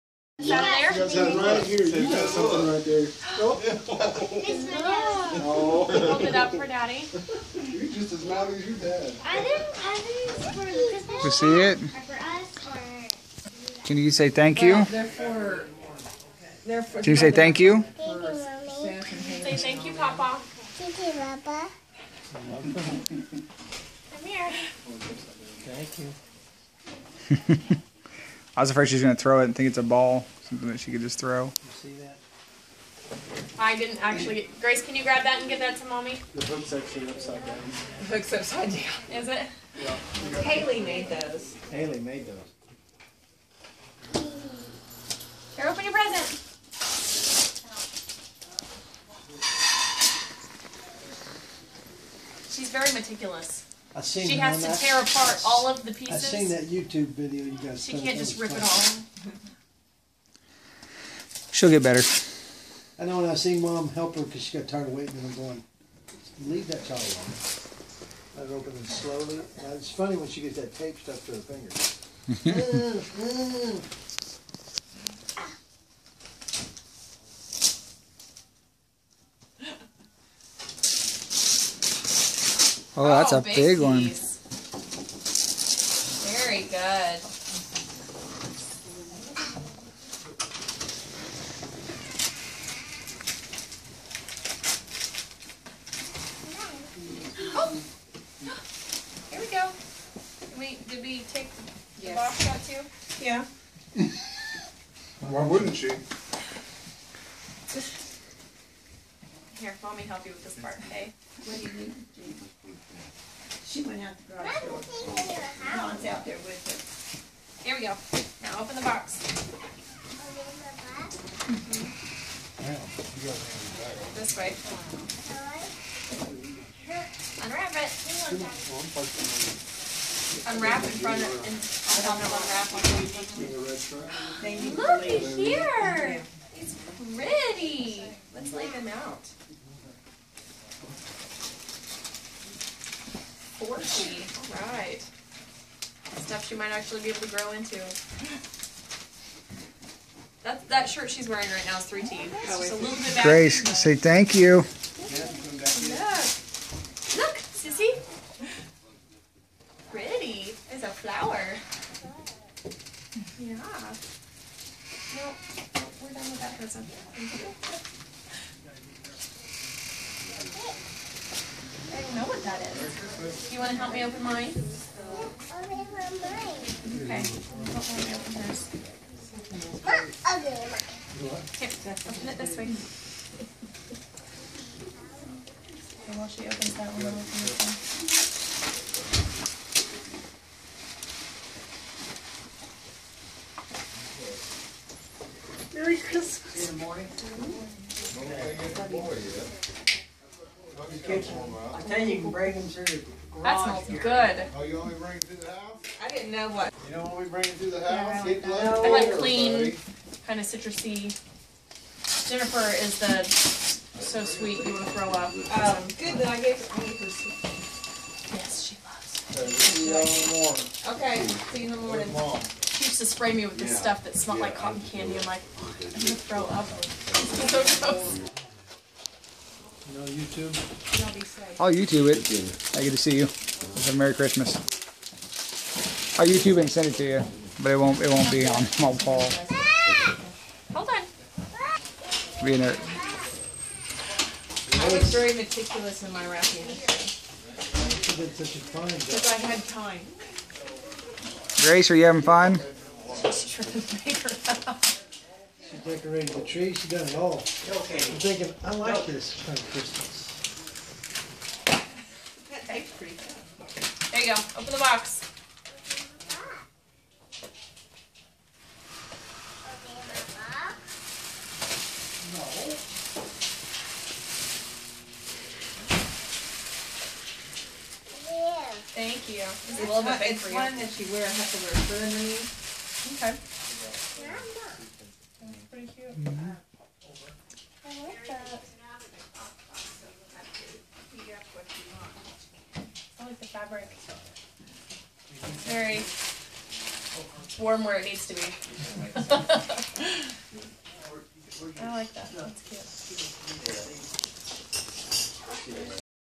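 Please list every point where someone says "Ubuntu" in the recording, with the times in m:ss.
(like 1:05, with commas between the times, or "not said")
not said.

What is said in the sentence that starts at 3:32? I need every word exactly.
Jennifer is the so sweet you want to throw up.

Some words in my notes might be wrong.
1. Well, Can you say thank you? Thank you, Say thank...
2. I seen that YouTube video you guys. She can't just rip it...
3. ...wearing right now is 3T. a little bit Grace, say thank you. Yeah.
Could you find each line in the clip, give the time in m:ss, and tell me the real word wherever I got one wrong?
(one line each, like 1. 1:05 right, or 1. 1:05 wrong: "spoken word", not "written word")
1. 0:14 right
2. 0:56 right
3. 2:31 right.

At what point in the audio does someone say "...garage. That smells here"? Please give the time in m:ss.
3:23.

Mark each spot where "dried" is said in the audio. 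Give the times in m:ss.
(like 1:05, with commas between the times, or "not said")
not said.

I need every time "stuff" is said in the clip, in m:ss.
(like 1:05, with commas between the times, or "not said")
2:26, 3:43.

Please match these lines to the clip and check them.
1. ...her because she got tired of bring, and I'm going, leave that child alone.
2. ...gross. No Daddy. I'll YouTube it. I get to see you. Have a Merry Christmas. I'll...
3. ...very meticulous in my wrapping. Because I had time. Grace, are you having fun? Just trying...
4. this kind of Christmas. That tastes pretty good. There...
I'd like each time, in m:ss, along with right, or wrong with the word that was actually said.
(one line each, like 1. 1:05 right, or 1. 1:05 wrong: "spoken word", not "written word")
1. 1:04 wrong: "waiting", not "bring"
2. 3:47 wrong: "YouTube", not "Daddy"
3. 4:05 right
4. 4:19 right.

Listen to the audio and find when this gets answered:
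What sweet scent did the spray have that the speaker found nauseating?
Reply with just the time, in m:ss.
3:44.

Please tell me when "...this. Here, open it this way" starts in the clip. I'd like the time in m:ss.
2:58.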